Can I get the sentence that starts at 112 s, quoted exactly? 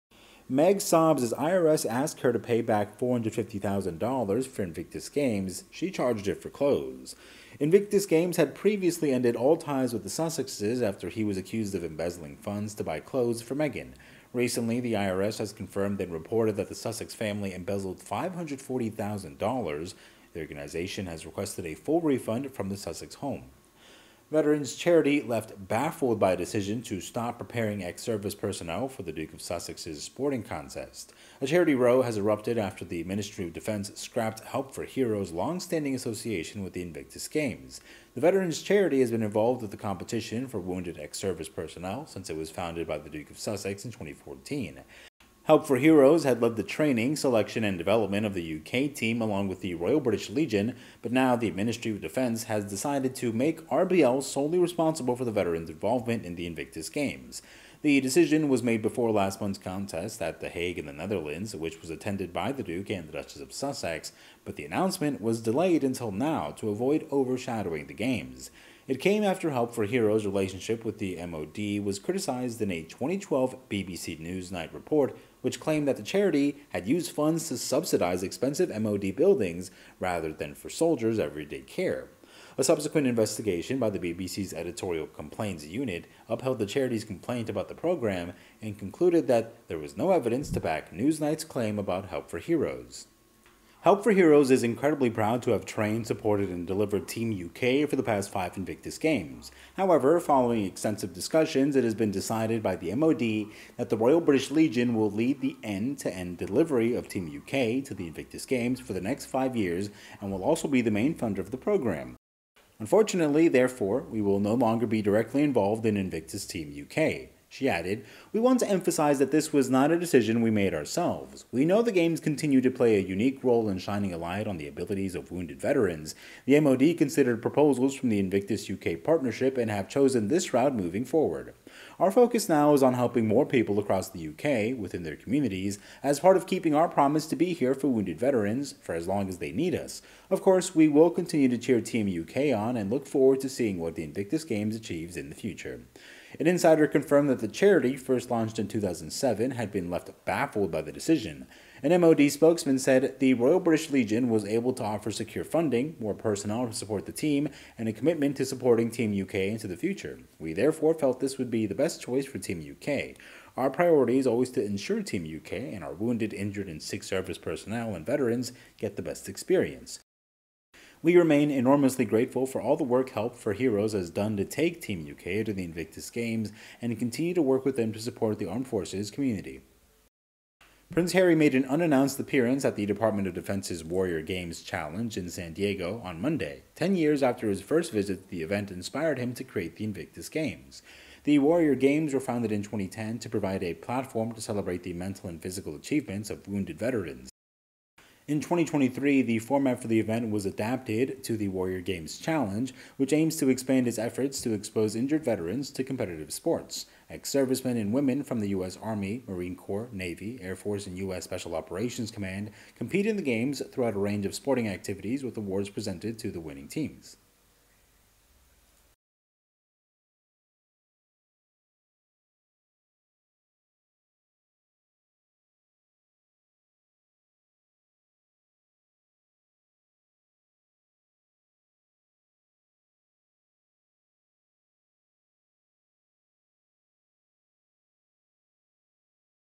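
Unfortunately, therefore, we will no longer be directly involved in Invictus Team UK.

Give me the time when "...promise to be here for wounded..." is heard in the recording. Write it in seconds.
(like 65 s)
136 s.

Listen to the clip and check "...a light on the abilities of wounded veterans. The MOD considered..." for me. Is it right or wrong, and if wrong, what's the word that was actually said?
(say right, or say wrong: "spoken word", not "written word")
right.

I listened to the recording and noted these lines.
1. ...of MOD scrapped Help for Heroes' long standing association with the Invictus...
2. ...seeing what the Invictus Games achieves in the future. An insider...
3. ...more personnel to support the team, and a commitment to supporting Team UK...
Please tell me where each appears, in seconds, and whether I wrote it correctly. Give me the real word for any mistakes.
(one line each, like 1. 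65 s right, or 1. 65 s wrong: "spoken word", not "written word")
1. 33 s wrong: "Defense", not "MOD"
2. 143 s right
3. 155 s right.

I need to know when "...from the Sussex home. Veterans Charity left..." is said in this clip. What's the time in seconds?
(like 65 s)
22 s.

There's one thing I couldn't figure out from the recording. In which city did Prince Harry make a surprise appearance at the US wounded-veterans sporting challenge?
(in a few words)
San Diego.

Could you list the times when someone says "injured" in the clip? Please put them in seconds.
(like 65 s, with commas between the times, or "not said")
166 s, 204 s.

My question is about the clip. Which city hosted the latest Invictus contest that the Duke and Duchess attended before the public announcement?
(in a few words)
The Hague.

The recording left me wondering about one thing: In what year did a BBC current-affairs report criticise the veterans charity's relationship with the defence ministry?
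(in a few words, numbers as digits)
2012.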